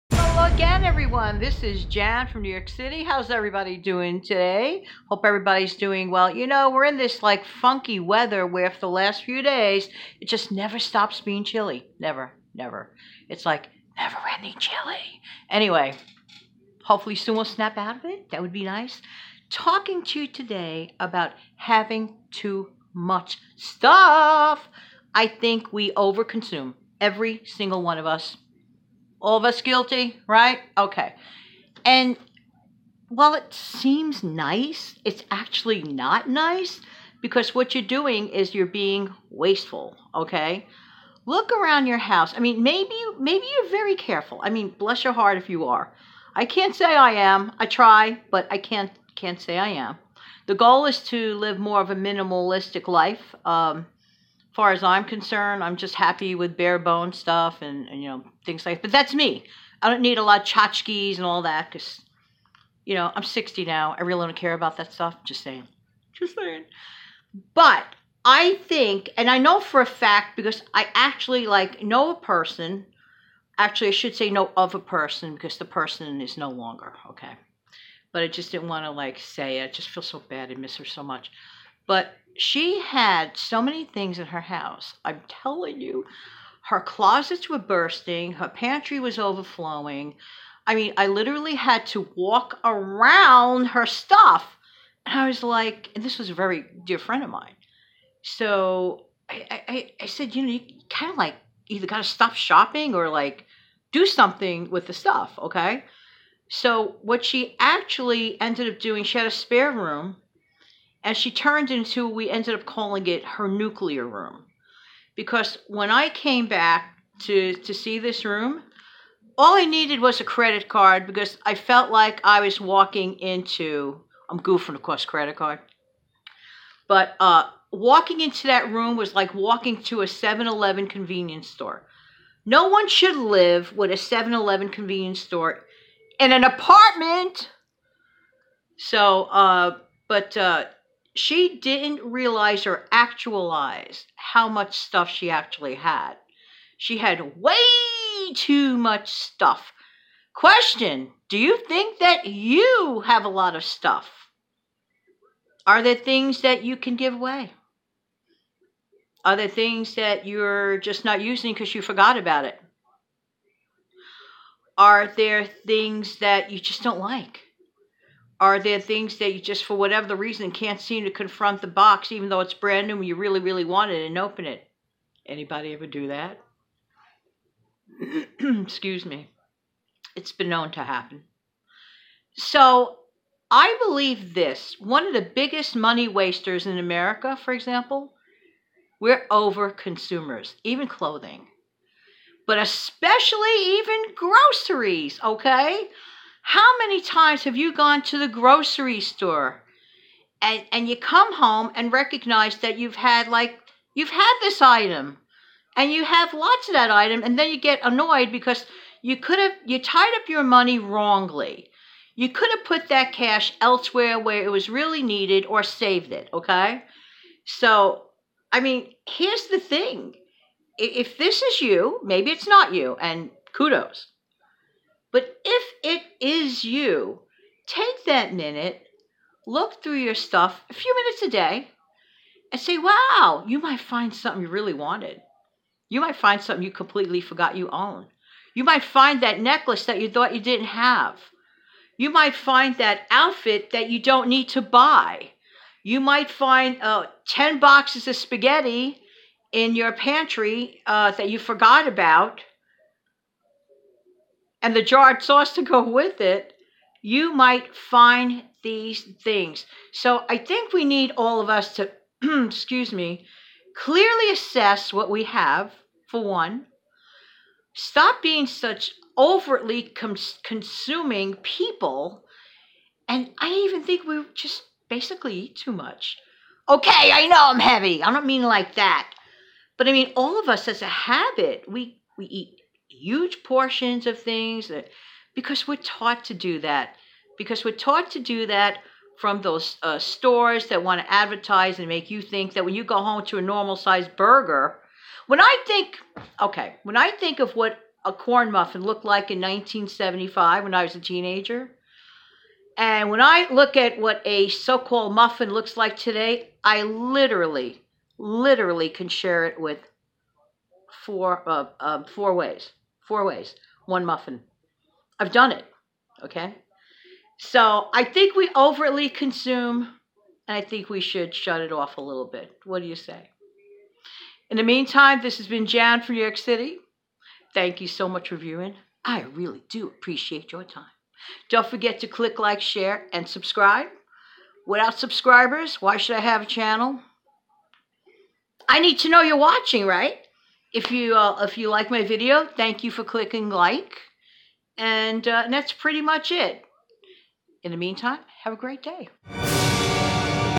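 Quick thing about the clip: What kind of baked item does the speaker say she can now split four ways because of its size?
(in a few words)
corn muffin.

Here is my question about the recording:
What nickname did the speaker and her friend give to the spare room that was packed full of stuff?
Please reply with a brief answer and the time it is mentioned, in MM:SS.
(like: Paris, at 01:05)
nuclear room, at 01:53.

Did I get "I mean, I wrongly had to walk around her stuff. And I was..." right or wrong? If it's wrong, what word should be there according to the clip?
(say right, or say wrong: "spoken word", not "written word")
wrong: "literally", not "wrongly".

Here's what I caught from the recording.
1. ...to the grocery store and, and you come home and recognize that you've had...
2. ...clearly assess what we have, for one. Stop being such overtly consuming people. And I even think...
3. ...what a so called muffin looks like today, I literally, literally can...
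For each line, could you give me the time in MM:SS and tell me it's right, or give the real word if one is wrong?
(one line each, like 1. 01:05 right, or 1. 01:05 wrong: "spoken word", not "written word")
1. 03:18 right
2. 04:23 right
3. 05:03 right.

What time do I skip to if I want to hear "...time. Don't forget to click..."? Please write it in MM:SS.
05:30.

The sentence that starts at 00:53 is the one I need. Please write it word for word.
Um, far as I'm concerned, I'm just happy with bare bone stuff and, and you know things like.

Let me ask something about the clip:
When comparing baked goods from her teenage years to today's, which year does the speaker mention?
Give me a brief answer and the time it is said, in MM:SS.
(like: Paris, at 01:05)
1975, at 04:59.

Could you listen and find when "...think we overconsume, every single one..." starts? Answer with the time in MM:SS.
00:25.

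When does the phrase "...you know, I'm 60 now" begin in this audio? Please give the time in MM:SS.
01:02.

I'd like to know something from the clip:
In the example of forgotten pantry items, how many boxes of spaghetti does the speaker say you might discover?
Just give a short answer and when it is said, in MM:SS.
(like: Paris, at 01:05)
10, at 04:07.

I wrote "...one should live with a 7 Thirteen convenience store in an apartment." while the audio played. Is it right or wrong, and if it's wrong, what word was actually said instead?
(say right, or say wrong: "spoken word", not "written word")
wrong: "Eleven", not "Thirteen".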